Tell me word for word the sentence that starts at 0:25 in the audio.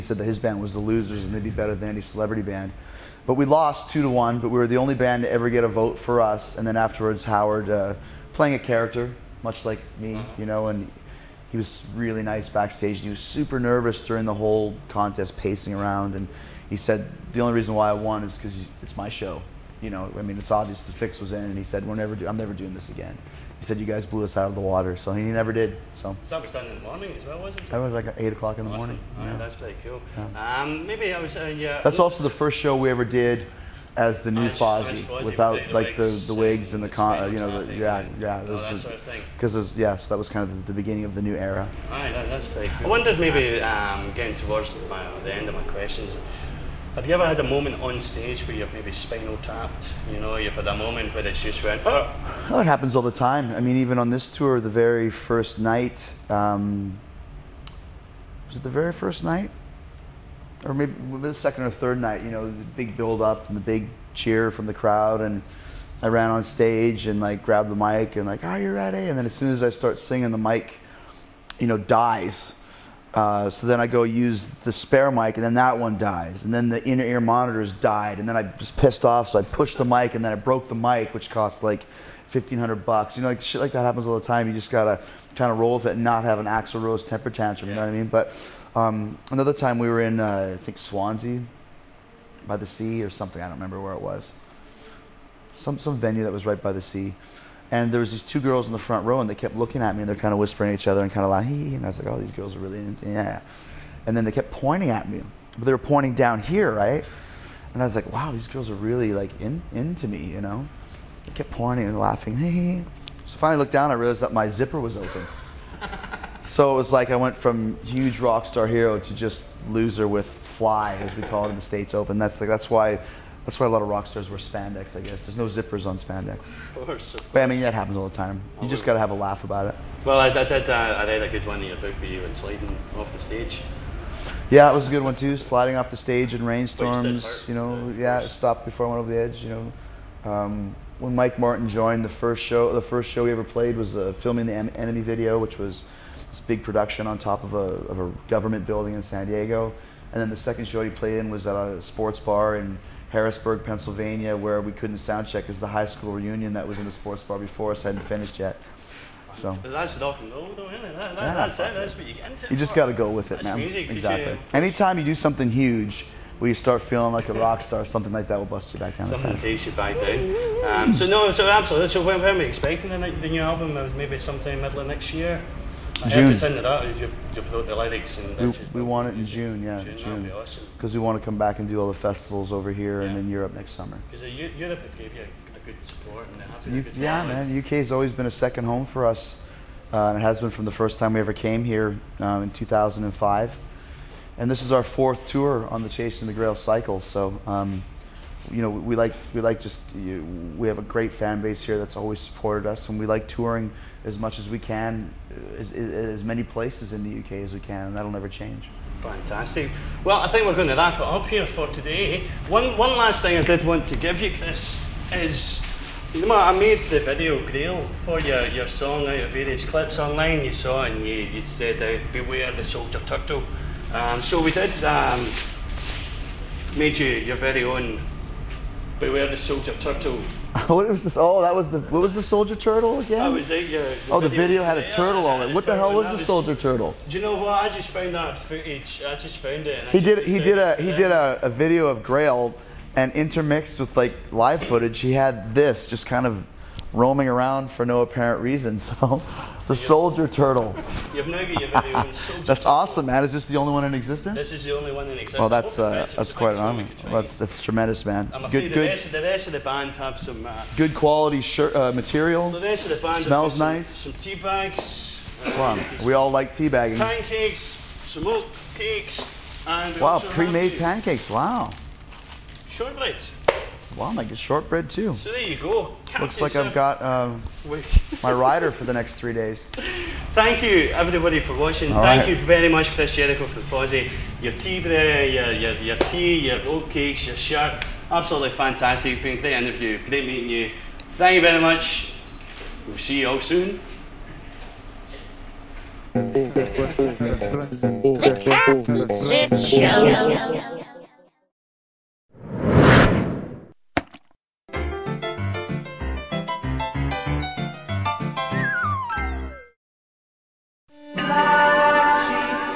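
So was done in the morning as well, wasn't it?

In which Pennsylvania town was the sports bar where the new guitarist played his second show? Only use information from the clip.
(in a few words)
Harrisburg.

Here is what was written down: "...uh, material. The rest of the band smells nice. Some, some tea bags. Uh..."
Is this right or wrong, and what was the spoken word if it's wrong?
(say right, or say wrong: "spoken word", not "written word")
right.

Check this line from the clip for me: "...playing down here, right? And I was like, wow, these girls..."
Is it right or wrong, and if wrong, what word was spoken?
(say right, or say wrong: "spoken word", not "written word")
wrong: "pointing", not "playing".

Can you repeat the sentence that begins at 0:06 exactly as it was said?
And then afterwards, Howard uh, playing a character much like me, uh-huh.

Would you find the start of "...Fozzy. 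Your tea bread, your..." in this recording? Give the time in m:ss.
4:43.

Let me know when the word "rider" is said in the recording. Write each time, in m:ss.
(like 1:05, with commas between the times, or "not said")
4:38.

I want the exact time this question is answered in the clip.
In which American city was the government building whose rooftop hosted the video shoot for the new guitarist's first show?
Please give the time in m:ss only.
2:29.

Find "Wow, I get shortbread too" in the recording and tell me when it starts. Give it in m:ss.
4:33.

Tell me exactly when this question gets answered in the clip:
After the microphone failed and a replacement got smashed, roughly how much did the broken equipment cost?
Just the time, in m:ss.
1:22.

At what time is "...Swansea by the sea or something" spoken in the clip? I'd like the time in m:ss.
1:30.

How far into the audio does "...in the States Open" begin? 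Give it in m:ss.
2:01.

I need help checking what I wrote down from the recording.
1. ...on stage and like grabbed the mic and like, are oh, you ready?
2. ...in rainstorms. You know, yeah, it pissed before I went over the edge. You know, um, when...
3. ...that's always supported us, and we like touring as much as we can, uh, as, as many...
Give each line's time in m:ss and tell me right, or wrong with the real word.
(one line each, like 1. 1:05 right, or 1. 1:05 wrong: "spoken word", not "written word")
1. 1:06 right
2. 2:16 wrong: "stopped", not "pissed"
3. 3:21 right.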